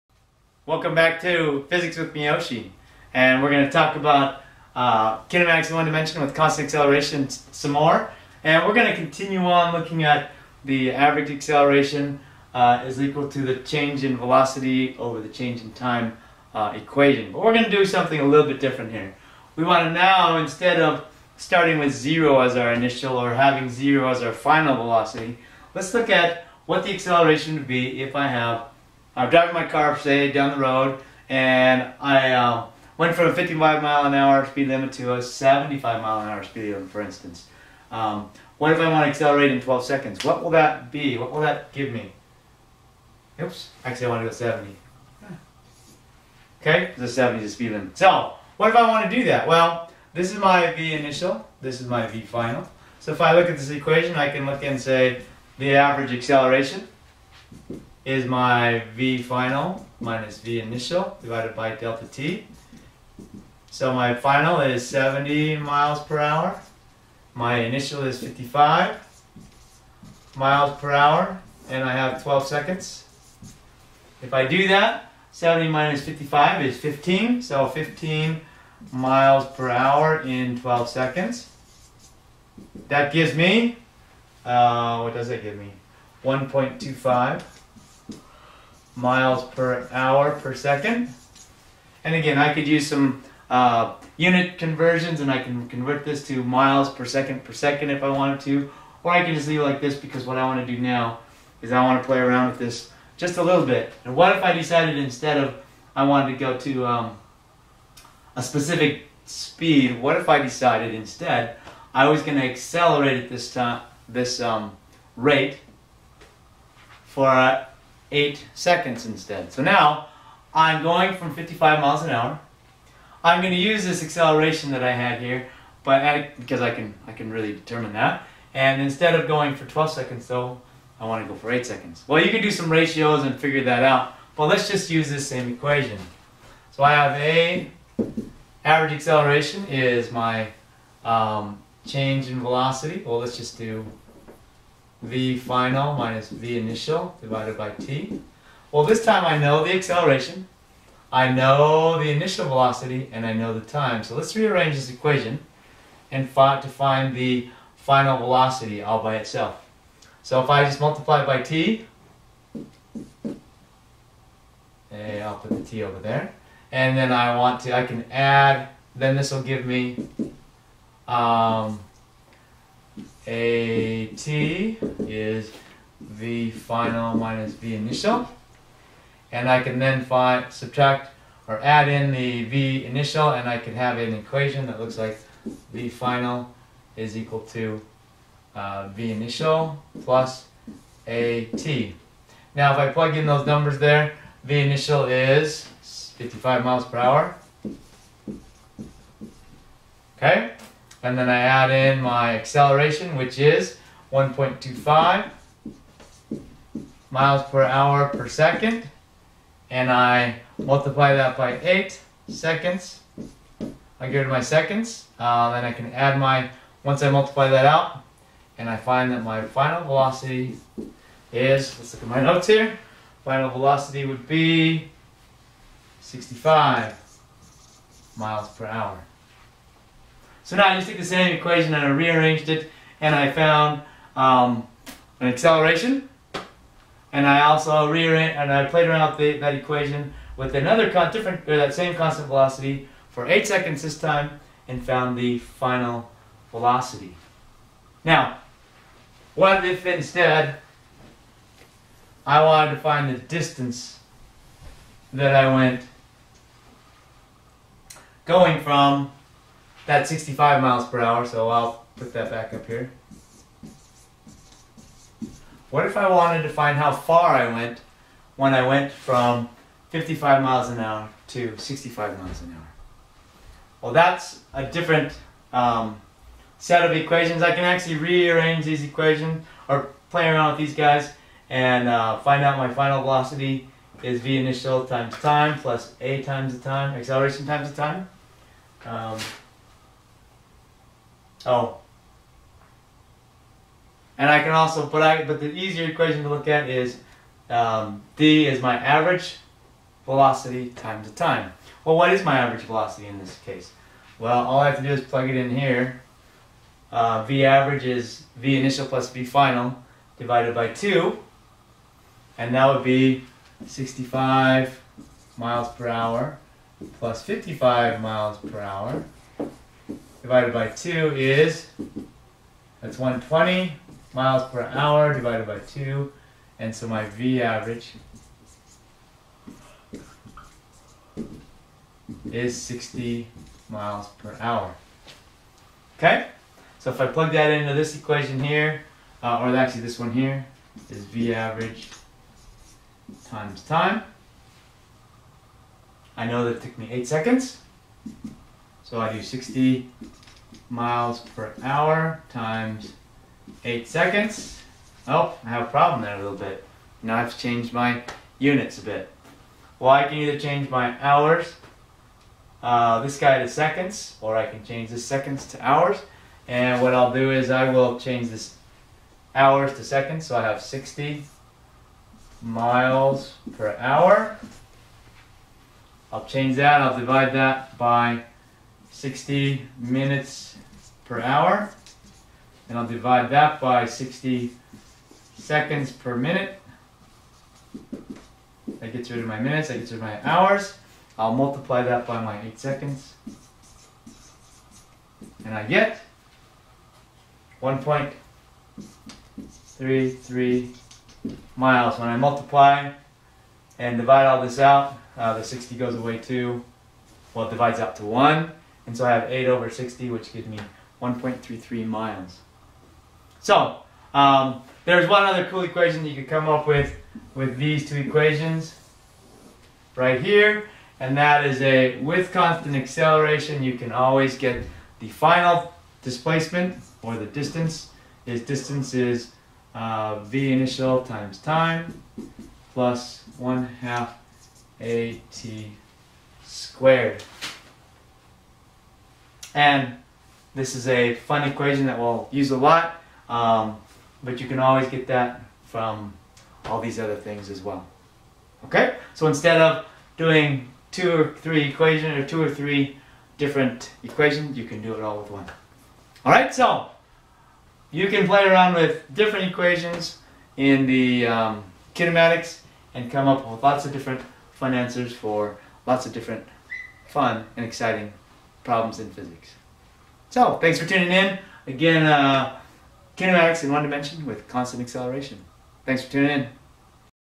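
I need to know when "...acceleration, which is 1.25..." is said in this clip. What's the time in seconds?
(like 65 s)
202 s.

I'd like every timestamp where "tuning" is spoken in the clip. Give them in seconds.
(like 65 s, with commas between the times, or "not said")
470 s, 476 s.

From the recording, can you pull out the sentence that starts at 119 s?
So now I'm going from 55 miles an hour.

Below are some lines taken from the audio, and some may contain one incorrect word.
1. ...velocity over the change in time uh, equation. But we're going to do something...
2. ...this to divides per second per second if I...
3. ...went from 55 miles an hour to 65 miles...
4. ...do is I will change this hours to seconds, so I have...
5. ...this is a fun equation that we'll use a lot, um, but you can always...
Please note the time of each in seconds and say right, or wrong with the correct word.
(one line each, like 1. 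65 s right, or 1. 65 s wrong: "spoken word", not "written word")
1. 14 s right
2. 96 s wrong: "miles", not "divides"
3. 268 s right
4. 367 s right
5. 440 s right.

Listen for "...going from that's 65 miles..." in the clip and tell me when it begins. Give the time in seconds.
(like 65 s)
258 s.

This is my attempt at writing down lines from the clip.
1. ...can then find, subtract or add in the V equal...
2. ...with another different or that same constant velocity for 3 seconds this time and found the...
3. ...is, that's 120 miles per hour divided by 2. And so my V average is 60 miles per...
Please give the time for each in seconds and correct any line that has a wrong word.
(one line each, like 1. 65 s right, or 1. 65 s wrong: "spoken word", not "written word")
1. 179 s wrong: "initial", not "equal"
2. 240 s wrong: "8", not "3"
3. 321 s right.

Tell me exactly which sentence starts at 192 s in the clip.
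Now if I plug in those numbers there, V initial is 55 miles per hour.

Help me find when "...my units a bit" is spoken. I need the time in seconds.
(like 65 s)
357 s.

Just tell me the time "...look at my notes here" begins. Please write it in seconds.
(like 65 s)
221 s.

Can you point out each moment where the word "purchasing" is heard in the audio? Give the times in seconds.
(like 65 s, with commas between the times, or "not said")
not said.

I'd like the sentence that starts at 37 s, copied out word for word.
Um, what if I want to accelerate in 12 seconds?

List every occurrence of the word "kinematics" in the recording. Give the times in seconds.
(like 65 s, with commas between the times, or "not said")
5 s, 461 s, 473 s.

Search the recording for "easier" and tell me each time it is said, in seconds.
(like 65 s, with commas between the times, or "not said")
295 s.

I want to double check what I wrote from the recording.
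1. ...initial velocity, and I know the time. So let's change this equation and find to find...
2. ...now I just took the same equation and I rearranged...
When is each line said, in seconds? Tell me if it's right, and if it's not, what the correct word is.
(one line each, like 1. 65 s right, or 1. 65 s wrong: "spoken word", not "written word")
1. 152 s wrong: "rearrange", not "change"
2. 230 s right.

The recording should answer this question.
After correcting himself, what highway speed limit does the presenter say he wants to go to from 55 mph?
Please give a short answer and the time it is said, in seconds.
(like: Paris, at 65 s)
70, at 46 s.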